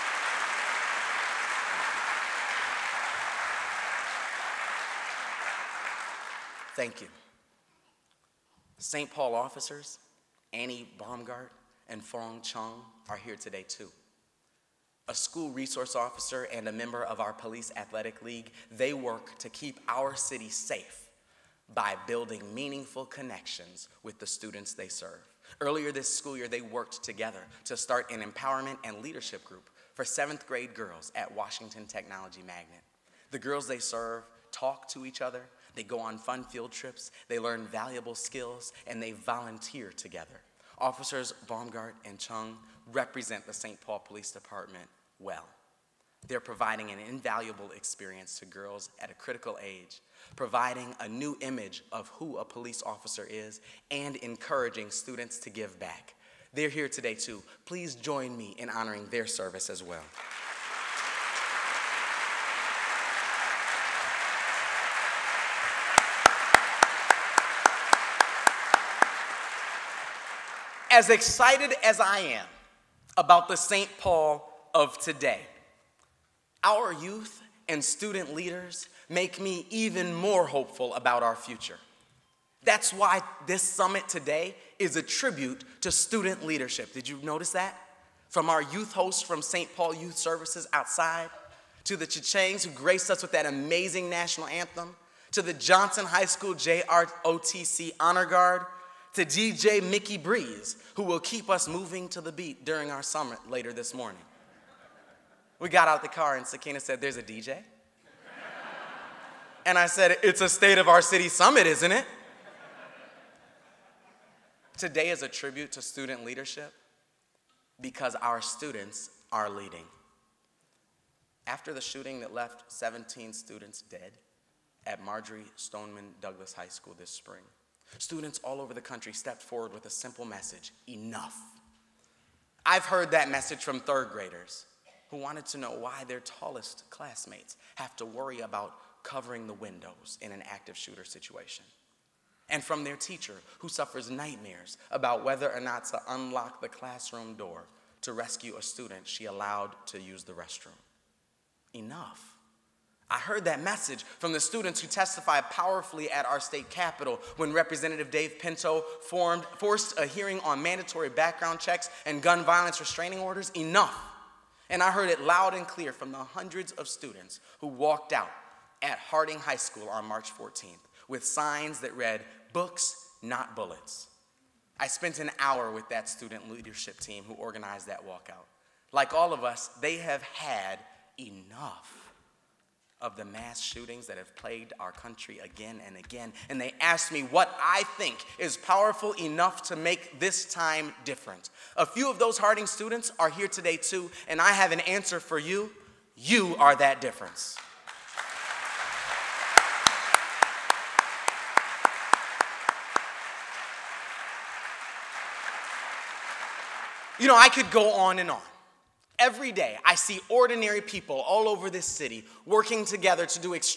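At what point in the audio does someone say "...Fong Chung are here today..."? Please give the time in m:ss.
0:12.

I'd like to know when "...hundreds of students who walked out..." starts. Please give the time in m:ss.
2:46.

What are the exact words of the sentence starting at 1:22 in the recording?
That's why this summit today is a tribute to student leadership.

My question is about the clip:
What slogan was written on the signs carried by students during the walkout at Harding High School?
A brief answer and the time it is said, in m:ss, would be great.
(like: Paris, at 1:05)
Books, not bullets, at 2:52.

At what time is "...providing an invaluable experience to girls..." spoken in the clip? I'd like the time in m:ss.
0:46.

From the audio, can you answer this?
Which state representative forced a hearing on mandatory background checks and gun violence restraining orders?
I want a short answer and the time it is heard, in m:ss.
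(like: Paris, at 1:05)
Dave Pinto, at 2:38.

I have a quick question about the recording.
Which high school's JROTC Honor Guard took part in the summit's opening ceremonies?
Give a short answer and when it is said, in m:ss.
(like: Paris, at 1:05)
Johnson High School, at 1:35.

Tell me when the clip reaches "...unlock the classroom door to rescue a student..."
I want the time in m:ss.
2:26.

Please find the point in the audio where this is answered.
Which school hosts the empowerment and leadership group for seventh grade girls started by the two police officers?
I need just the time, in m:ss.
0:31.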